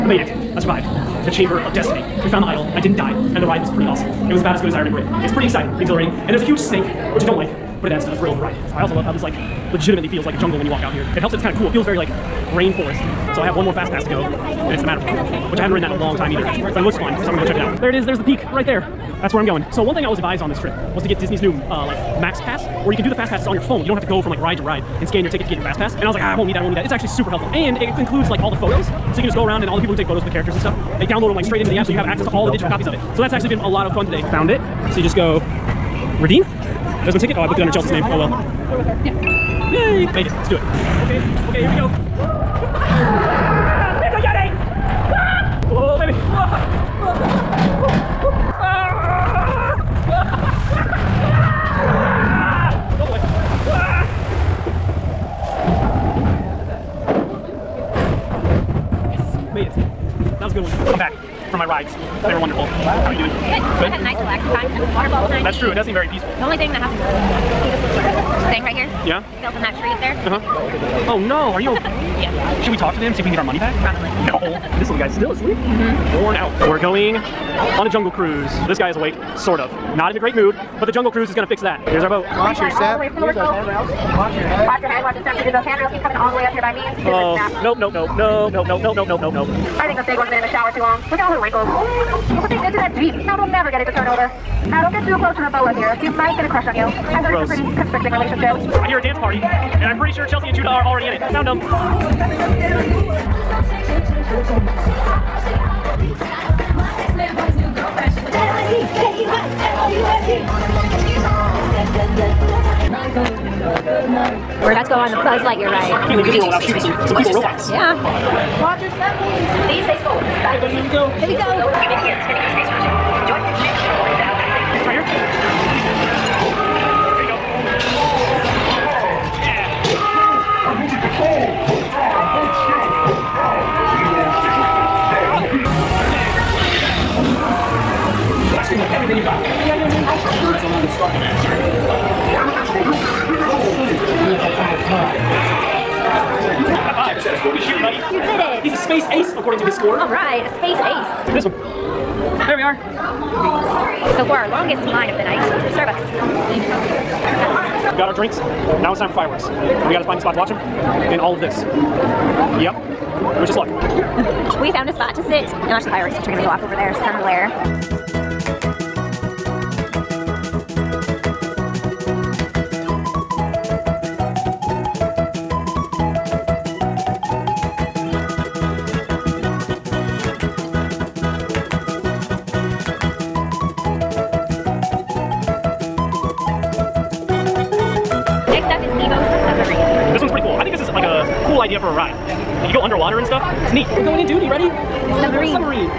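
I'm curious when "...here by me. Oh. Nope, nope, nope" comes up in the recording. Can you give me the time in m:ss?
1:26.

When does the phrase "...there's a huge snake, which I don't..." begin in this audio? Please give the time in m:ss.
0:06.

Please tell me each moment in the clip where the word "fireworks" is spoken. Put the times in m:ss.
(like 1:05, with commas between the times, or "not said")
2:39, 2:45.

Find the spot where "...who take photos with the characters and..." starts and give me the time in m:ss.
0:29.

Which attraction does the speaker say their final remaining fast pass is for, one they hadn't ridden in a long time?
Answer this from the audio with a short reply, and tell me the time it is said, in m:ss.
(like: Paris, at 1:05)
Matterhorn, at 0:14.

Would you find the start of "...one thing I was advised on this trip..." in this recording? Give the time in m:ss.
0:19.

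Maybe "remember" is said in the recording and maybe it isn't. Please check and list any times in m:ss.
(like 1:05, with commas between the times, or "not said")
0:04.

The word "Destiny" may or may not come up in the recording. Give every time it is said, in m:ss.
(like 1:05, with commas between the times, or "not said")
0:01.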